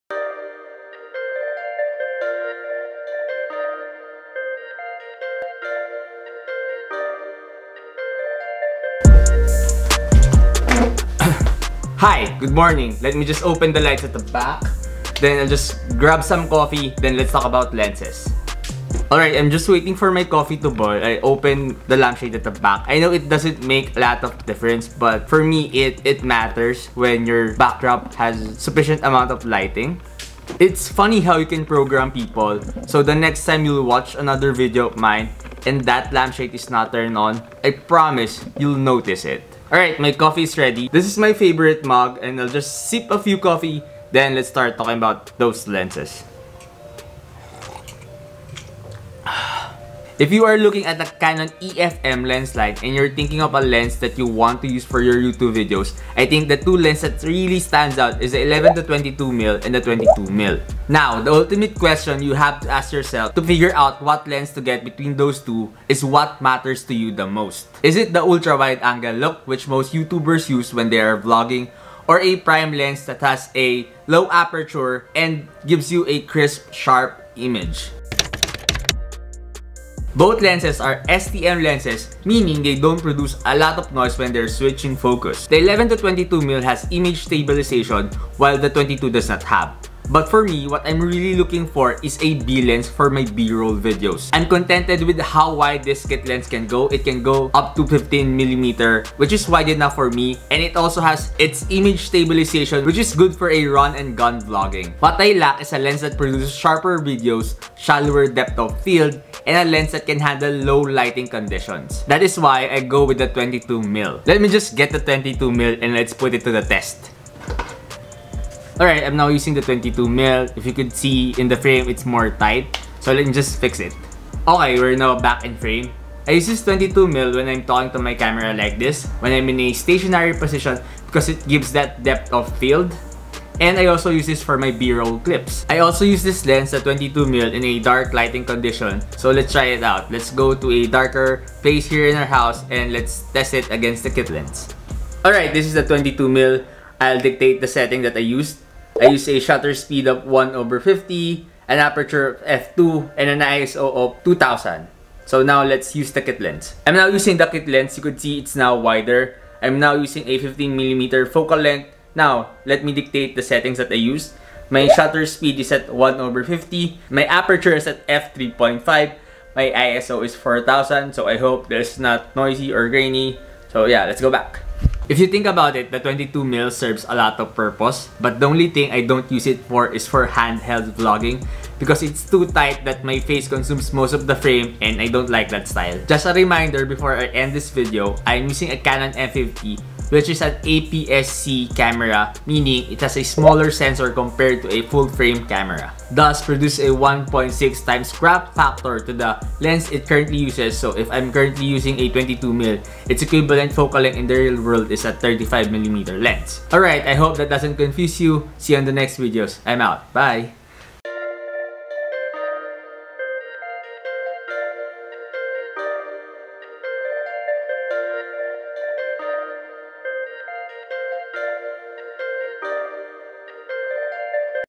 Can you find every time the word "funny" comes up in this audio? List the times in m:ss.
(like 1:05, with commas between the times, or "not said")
0:30.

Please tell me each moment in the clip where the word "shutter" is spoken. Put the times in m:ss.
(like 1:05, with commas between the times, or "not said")
2:29, 2:44.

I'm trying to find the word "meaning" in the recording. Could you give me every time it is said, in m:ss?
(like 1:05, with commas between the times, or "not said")
1:22, 3:12.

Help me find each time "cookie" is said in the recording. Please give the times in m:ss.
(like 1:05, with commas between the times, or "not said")
not said.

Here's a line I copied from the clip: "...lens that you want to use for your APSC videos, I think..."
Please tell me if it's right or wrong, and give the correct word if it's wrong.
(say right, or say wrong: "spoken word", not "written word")
wrong: "YouTube", not "APSC".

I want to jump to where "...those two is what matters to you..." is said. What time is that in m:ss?
1:05.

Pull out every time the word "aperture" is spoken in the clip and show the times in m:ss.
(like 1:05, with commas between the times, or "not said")
1:14, 2:31, 2:47.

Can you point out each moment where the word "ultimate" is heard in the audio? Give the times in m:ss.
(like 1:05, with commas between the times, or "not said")
1:01.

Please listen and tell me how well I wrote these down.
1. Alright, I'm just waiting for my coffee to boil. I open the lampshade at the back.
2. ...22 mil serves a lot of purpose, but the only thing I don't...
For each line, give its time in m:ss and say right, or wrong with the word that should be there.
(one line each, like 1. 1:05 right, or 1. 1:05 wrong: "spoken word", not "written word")
1. 0:19 right
2. 2:55 right.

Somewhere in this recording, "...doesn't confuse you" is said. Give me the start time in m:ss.
3:27.